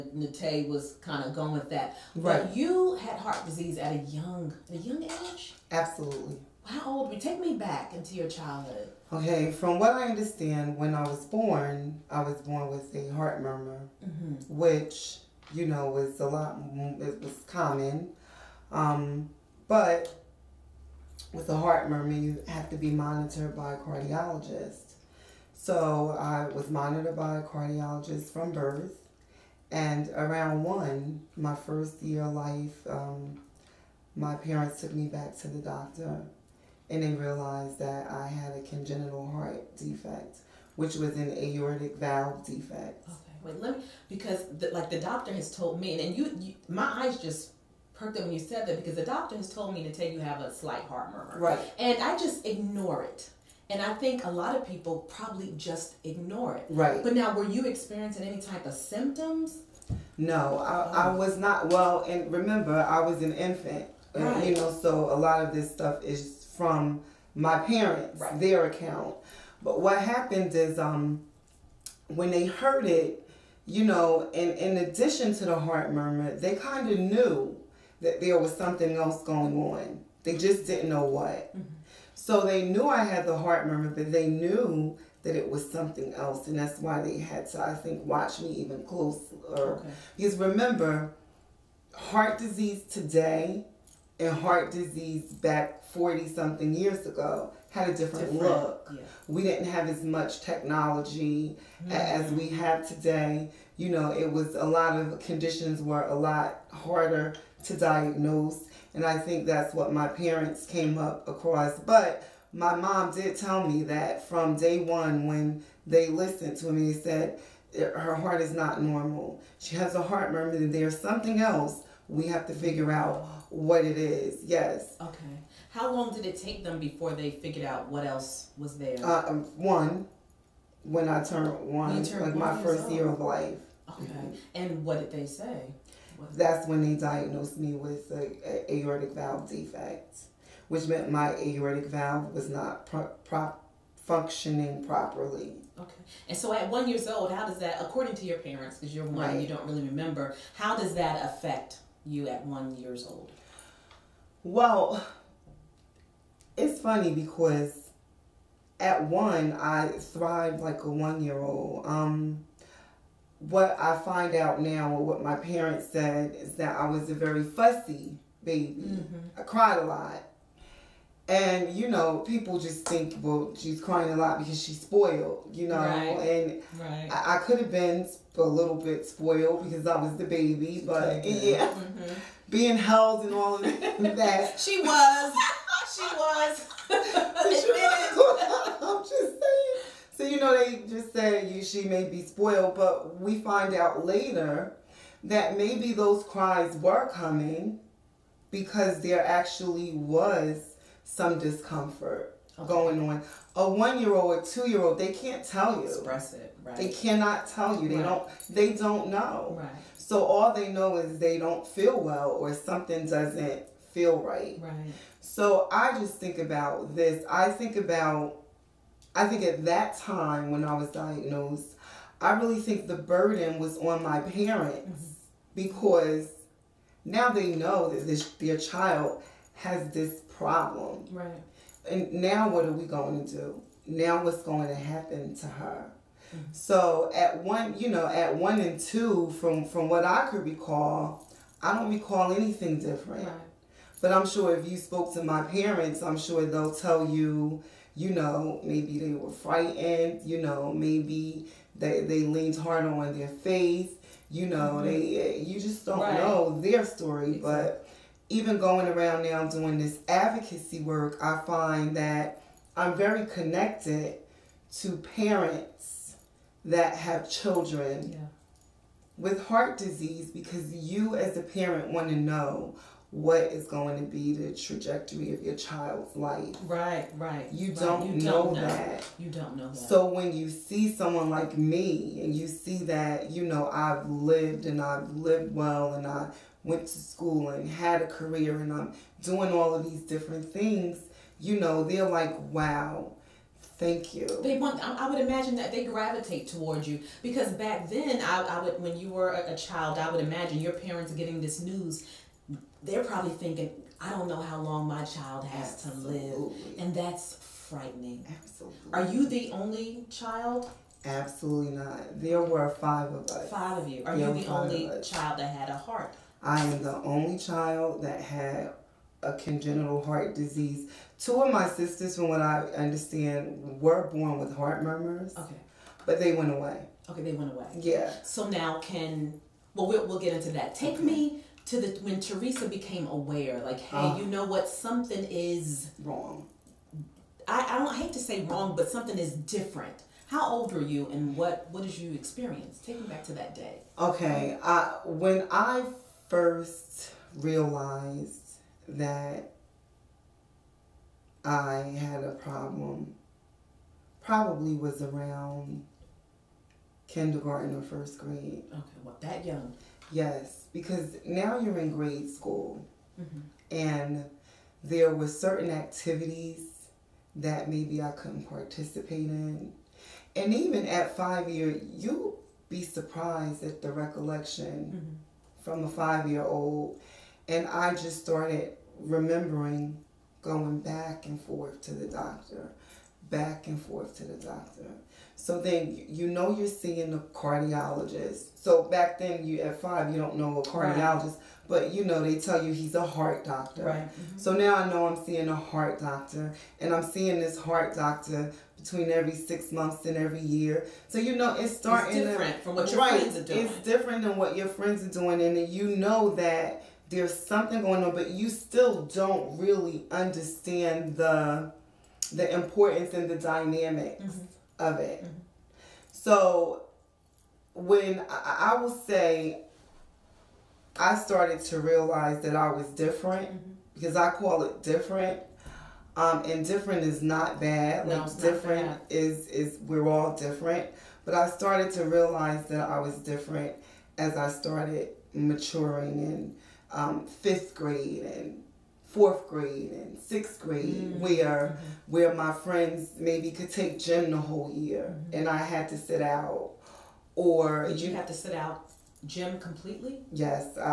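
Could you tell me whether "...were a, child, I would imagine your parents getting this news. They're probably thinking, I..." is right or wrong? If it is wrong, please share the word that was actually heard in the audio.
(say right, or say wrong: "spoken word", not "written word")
right.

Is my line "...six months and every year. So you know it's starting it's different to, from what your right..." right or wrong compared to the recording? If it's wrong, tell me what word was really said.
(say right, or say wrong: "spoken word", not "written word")
right.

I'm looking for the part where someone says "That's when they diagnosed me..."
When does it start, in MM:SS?
02:16.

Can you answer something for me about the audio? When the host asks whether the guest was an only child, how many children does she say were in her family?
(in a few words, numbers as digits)
5.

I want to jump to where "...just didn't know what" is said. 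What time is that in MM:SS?
01:20.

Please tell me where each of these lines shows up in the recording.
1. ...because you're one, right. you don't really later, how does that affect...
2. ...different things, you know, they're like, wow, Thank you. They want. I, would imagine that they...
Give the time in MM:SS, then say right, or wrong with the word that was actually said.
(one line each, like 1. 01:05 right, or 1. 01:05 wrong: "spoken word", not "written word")
1. 02:28 wrong: "remember", not "later"
2. 04:50 right.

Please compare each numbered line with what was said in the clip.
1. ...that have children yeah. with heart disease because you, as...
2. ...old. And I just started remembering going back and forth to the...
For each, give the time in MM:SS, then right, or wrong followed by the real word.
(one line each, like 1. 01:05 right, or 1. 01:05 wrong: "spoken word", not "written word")
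1. 04:26 right
2. 06:16 right.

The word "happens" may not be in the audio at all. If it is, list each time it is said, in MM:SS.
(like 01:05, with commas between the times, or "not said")
01:09, 03:54.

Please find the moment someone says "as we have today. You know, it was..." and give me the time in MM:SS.
01:41.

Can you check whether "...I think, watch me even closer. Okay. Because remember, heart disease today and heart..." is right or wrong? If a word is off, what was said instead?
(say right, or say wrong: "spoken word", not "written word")
right.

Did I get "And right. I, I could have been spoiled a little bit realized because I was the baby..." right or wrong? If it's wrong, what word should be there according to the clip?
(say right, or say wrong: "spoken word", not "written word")
wrong: "spoiled", not "realized".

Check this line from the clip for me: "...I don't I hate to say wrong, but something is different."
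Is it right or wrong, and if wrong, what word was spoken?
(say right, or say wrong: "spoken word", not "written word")
right.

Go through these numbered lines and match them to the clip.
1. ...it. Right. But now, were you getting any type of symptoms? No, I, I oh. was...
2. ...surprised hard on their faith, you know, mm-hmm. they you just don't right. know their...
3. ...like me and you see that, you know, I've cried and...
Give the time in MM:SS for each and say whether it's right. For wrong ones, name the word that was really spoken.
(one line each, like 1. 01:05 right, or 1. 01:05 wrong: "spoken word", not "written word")
1. 00:56 wrong: "experiencing", not "getting"
2. 04:12 wrong: "leaned", not "surprised"
3. 04:41 wrong: "lived", not "cried".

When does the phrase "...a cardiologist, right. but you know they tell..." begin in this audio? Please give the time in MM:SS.
06:30.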